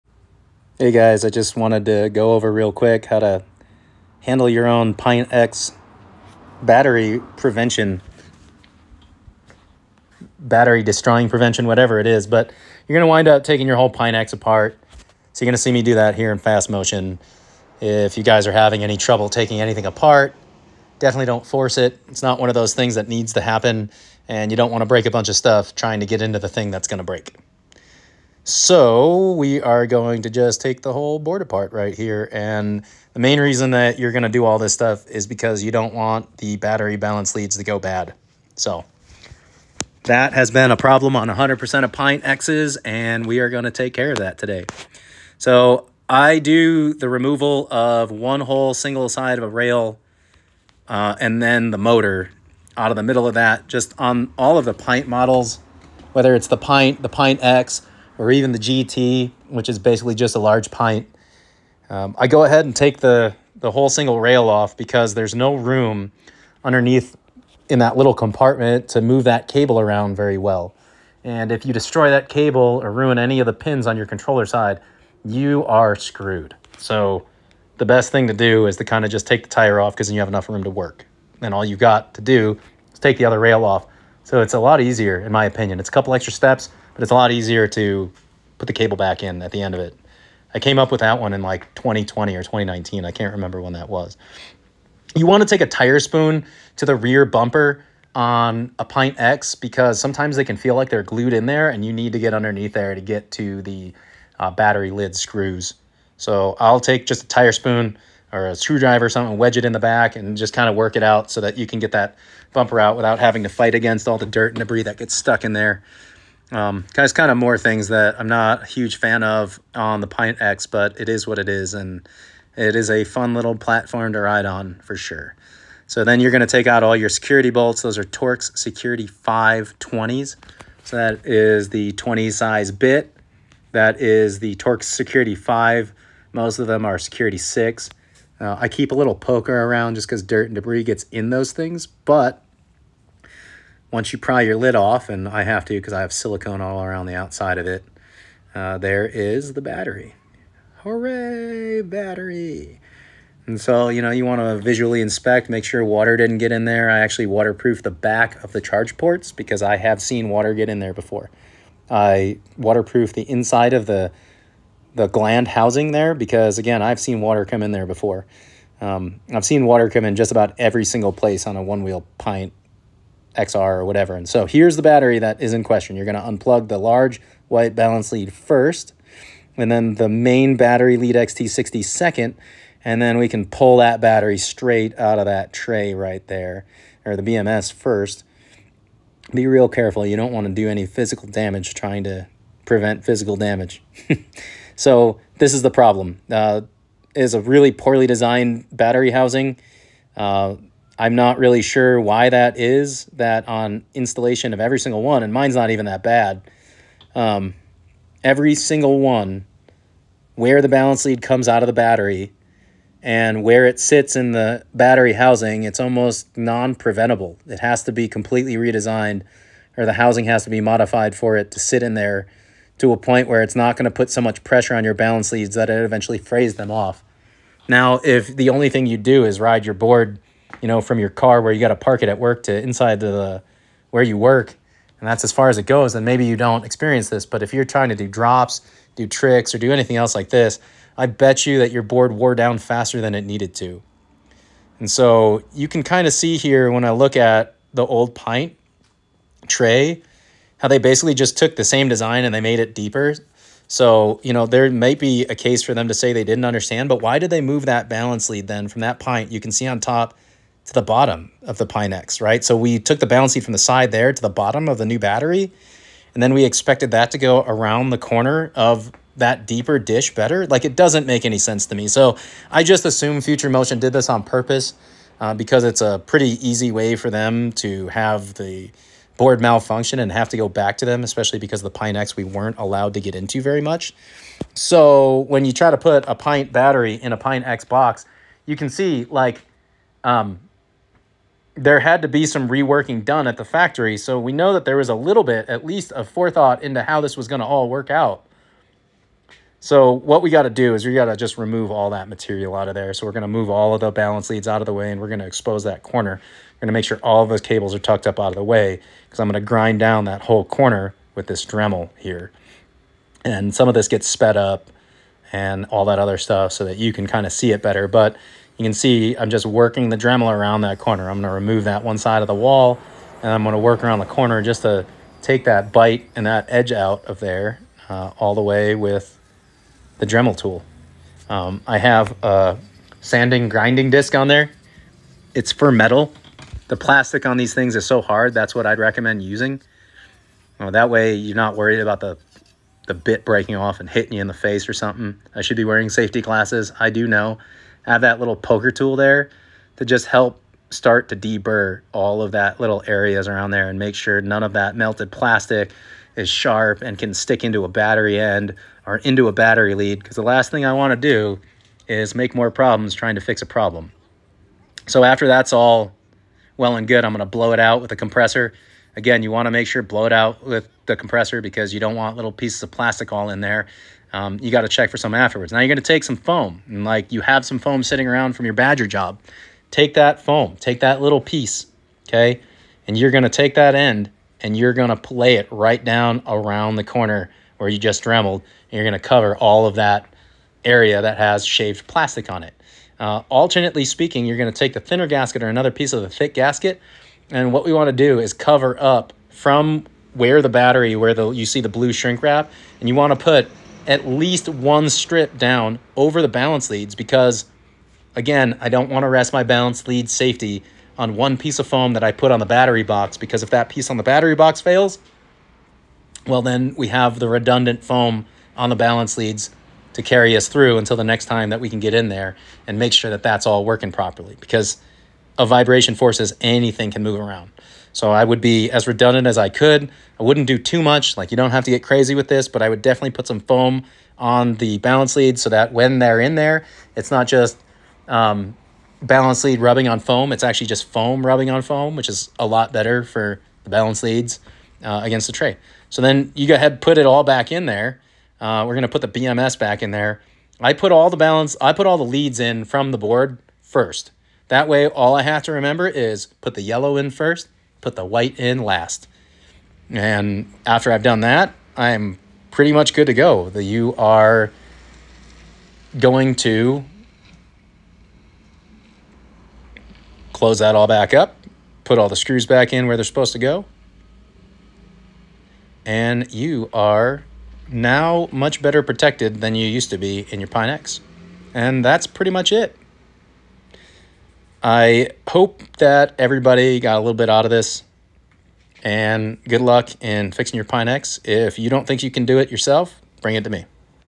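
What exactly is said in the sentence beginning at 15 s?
So you're going to see me do that here in fast motion.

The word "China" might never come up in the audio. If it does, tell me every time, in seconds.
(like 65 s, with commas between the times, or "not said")
not said.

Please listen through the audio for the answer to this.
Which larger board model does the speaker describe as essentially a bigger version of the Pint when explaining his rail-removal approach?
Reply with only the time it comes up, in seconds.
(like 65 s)
58 s.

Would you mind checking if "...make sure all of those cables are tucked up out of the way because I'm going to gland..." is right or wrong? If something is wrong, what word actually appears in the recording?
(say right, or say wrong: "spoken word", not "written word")
wrong: "grind", not "gland".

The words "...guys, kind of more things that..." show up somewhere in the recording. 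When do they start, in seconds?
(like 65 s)
116 s.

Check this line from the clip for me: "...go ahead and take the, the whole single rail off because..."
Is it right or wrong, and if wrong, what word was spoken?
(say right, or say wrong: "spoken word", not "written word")
right.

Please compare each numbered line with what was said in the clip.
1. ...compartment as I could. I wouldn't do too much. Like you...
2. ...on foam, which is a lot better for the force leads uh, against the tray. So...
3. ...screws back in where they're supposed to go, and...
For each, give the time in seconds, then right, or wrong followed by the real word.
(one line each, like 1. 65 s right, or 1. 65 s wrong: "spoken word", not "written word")
1. 428 s wrong: "redundant", not "compartment"
2. 441 s wrong: "balance", not "force"
3. 472 s right.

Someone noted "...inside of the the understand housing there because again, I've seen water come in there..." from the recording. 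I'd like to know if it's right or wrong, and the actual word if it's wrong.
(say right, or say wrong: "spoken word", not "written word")
wrong: "gland", not "understand".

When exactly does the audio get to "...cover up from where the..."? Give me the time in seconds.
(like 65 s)
398 s.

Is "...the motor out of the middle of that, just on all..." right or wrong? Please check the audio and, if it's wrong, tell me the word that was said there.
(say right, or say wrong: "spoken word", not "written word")
right.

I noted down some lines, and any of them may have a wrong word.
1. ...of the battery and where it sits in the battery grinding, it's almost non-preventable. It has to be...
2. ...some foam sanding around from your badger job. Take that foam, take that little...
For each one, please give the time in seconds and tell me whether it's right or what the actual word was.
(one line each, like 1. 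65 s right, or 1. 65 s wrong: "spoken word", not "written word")
1. 211 s wrong: "housing", not "grinding"
2. 377 s wrong: "sitting", not "sanding".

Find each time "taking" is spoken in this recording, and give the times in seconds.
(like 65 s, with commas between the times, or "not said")
13 s, 19 s.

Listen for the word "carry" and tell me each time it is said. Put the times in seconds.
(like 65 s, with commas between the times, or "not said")
420 s.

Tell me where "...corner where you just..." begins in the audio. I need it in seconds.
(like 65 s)
386 s.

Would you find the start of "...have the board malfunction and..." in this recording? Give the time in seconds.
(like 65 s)
277 s.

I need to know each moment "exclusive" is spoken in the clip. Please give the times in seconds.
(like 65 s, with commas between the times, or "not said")
not said.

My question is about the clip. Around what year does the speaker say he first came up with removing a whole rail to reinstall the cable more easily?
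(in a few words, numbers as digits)
2020.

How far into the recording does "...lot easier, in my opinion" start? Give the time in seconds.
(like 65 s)
84 s.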